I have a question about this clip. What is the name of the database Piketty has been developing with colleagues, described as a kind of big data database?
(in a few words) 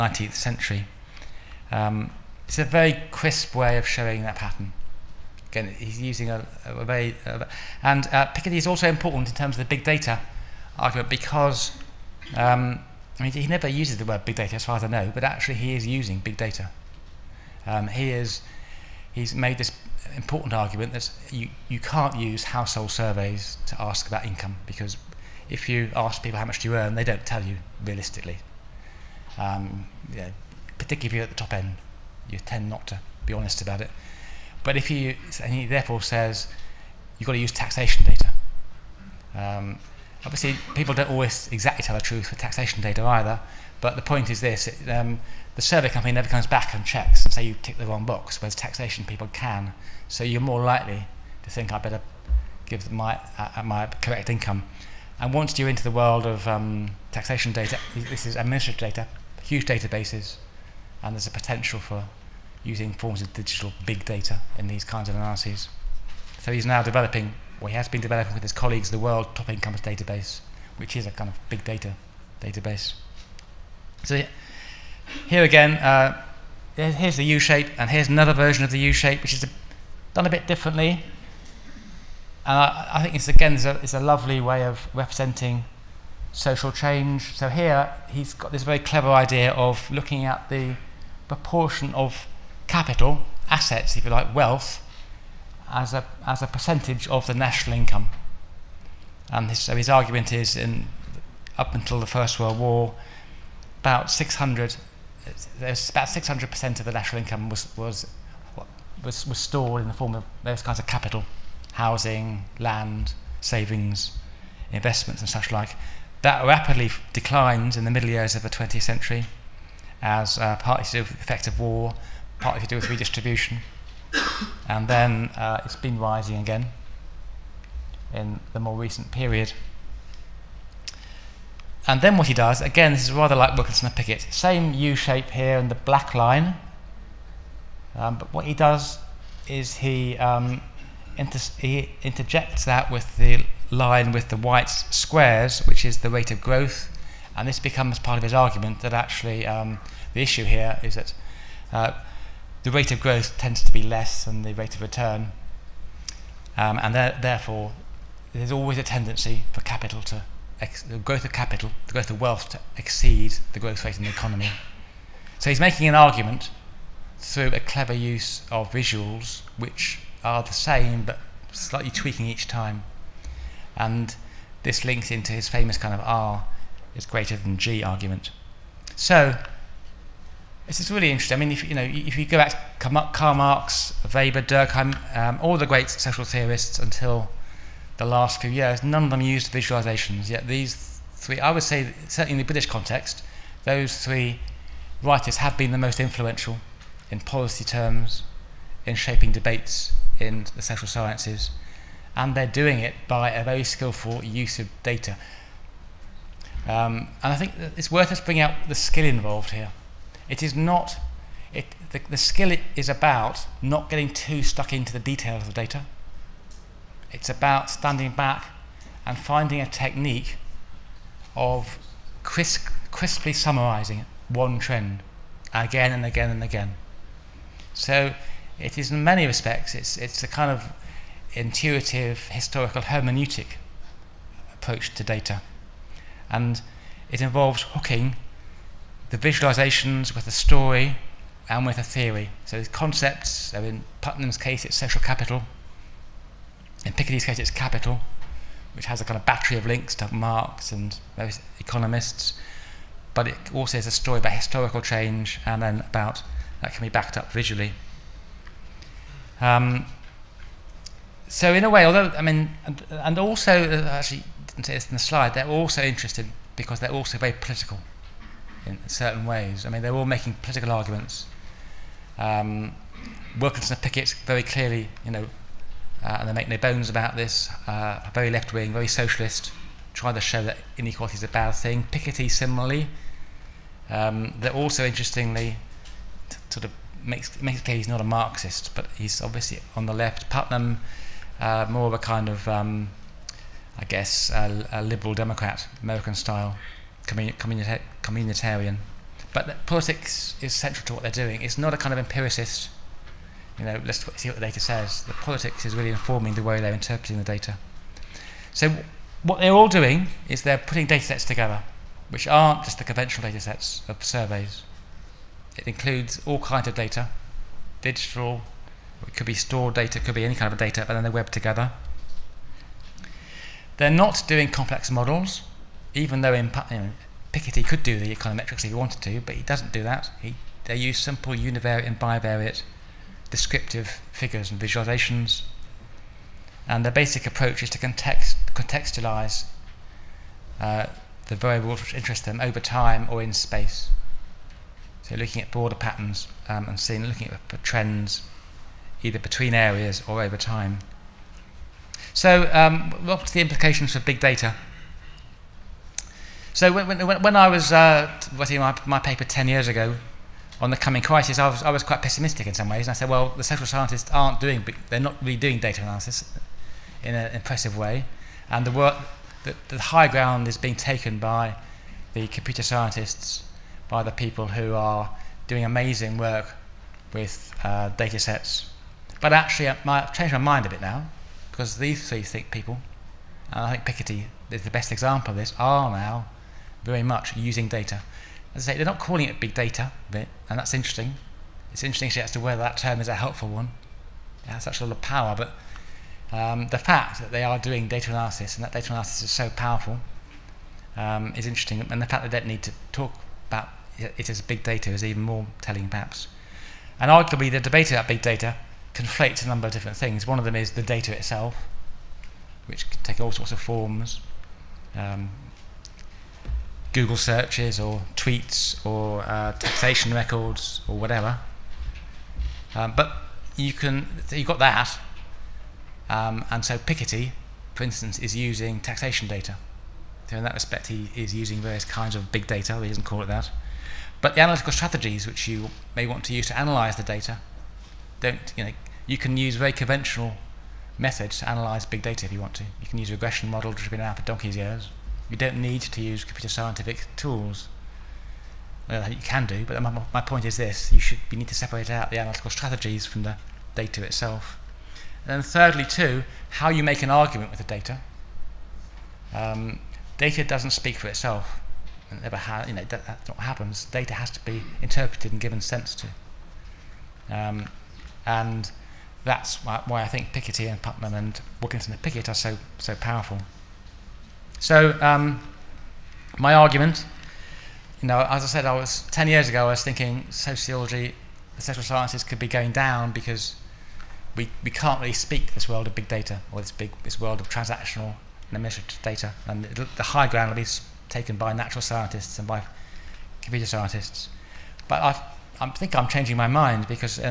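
World Top Incomes Database.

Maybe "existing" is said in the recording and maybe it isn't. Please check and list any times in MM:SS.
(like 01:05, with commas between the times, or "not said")
not said.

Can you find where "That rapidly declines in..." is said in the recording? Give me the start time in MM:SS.
01:56.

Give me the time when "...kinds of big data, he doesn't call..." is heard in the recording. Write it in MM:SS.
07:11.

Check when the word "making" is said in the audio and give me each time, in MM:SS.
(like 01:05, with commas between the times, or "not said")
02:45, 04:30.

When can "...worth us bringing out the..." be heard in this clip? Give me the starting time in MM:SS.
03:27.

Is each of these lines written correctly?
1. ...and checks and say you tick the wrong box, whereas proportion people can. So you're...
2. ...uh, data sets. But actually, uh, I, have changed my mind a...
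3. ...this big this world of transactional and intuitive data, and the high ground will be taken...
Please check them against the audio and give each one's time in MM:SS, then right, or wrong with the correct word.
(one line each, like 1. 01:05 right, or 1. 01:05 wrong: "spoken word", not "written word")
1. 00:46 wrong: "taxation", not "proportion"
2. 06:17 right
3. 08:06 wrong: "administrative", not "intuitive".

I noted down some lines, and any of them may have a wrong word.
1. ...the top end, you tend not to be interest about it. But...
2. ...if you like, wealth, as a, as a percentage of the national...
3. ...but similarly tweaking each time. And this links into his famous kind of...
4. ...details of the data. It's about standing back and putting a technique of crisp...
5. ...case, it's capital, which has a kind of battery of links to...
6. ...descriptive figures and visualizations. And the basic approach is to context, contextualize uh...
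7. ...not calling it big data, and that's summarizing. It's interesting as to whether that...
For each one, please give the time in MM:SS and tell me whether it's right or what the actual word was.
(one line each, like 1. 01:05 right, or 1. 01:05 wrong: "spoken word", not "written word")
1. 00:31 wrong: "honest", not "interest"
2. 01:33 right
3. 02:51 wrong: "slightly", not "similarly"
4. 03:34 wrong: "finding", not "putting"
5. 04:07 right
6. 05:33 right
7. 06:28 wrong: "interesting", not "summarizing".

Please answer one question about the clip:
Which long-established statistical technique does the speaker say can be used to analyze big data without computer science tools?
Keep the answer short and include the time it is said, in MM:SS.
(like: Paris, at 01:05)
regression models, at 07:23.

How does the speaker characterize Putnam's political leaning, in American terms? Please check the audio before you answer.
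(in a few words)
communitarian.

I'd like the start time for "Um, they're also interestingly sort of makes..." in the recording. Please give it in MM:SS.
04:43.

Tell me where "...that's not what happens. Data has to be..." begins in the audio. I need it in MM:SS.
07:43.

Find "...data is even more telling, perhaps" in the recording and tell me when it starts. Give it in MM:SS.
06:44.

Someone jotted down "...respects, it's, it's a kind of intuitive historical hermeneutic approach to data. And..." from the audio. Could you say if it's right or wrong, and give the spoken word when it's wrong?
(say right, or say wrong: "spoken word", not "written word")
right.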